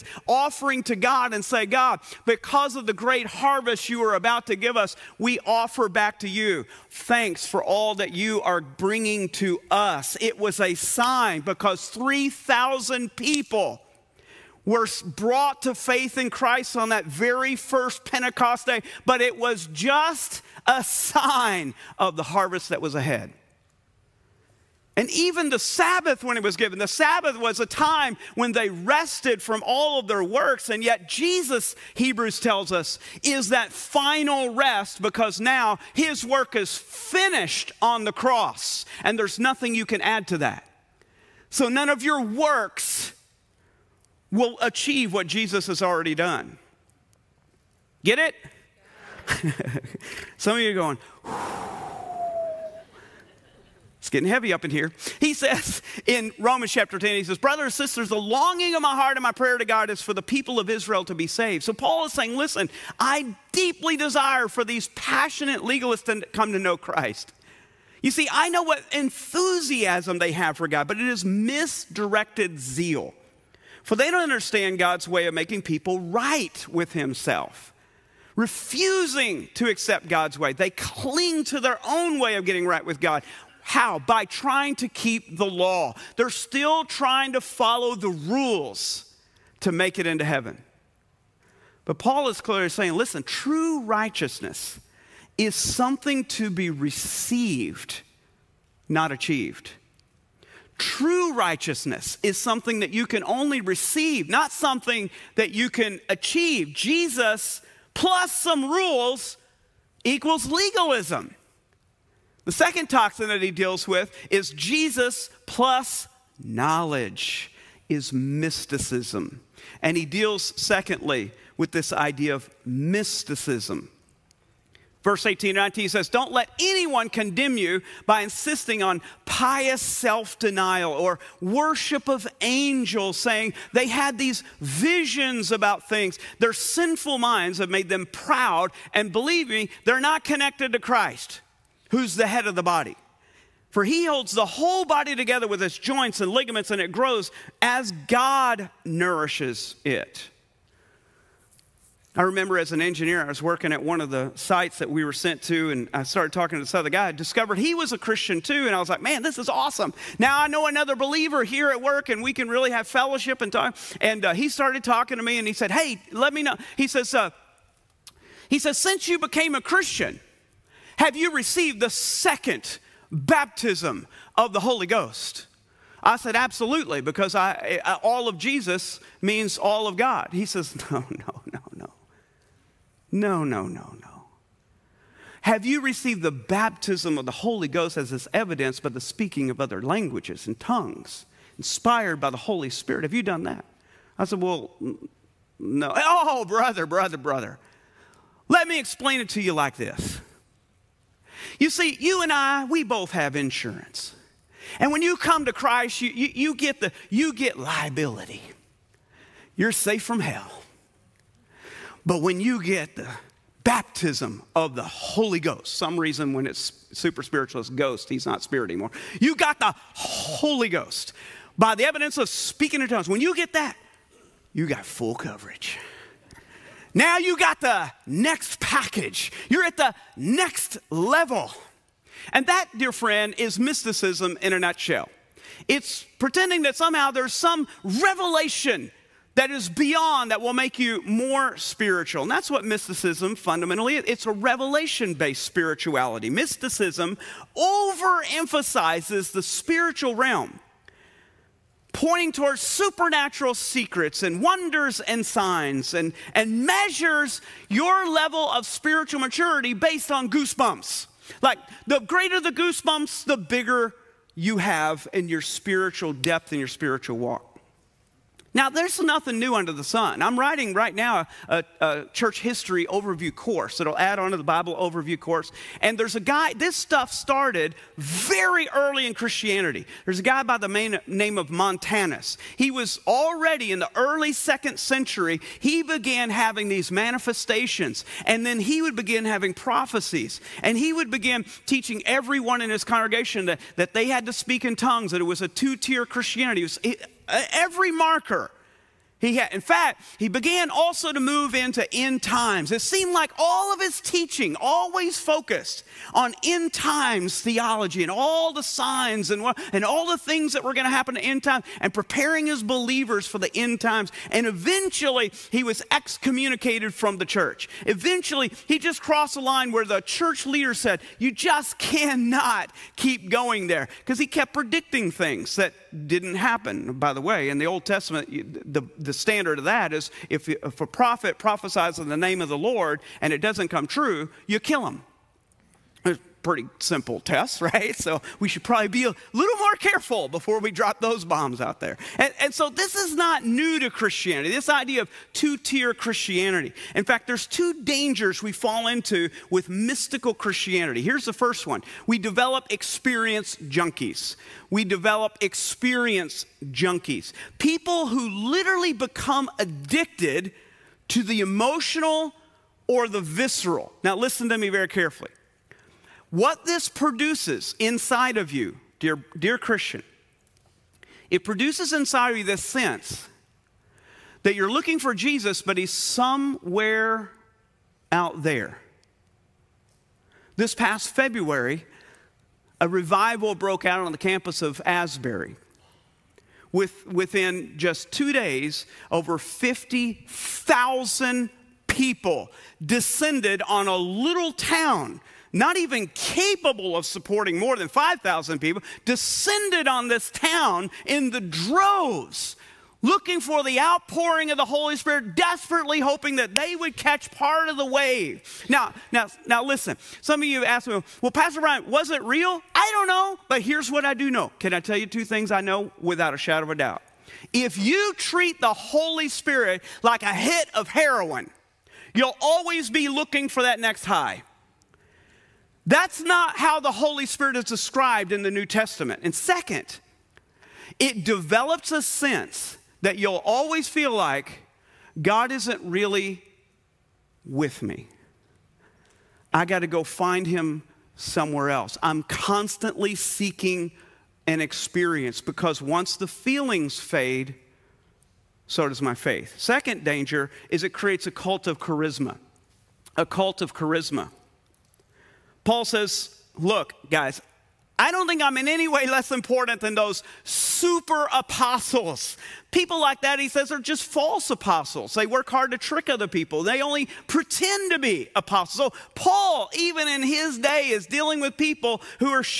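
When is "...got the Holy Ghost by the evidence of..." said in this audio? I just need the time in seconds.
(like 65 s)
219 s.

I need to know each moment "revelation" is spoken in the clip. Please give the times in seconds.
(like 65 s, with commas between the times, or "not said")
237 s, 244 s.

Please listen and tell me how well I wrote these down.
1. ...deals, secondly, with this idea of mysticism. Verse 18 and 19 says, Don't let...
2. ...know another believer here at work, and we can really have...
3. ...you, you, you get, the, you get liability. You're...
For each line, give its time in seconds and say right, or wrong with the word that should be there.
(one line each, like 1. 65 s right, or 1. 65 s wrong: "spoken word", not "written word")
1. 120 s right
2. 160 s right
3. 206 s right.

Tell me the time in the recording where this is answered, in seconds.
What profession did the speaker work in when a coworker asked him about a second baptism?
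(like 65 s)
152 s.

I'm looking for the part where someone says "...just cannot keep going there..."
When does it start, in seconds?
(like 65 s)
321 s.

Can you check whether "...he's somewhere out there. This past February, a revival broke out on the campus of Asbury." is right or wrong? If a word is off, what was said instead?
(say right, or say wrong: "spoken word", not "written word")
right.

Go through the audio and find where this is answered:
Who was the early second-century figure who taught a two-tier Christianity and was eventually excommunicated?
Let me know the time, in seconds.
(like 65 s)
281 s.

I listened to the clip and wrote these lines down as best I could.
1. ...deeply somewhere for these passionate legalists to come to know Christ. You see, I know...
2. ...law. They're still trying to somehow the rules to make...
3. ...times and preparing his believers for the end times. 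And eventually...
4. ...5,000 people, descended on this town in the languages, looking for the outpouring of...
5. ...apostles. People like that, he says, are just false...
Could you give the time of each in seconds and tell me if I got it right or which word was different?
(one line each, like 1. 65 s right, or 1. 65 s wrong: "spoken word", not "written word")
1. 63 s wrong: "desire", not "somewhere"
2. 85 s wrong: "follow", not "somehow"
3. 311 s right
4. 397 s wrong: "droves", not "languages"
5. 461 s right.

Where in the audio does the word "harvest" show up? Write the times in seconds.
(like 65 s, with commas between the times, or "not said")
3 s, 22 s.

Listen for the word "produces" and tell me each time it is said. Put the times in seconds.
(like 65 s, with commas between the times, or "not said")
366 s, 371 s.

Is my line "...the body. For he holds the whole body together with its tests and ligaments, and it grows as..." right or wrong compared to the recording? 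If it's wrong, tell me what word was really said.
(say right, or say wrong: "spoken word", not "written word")
wrong: "joints", not "tests".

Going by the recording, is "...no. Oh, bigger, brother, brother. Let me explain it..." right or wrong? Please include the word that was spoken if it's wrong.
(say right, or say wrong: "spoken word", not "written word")
wrong: "brother", not "bigger".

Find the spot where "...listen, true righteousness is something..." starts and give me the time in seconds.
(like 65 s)
92 s.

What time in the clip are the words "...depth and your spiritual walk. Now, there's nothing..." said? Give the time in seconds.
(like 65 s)
266 s.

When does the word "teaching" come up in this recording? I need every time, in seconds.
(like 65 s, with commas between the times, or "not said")
291 s, 304 s.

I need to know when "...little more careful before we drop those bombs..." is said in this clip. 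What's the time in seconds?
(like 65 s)
339 s.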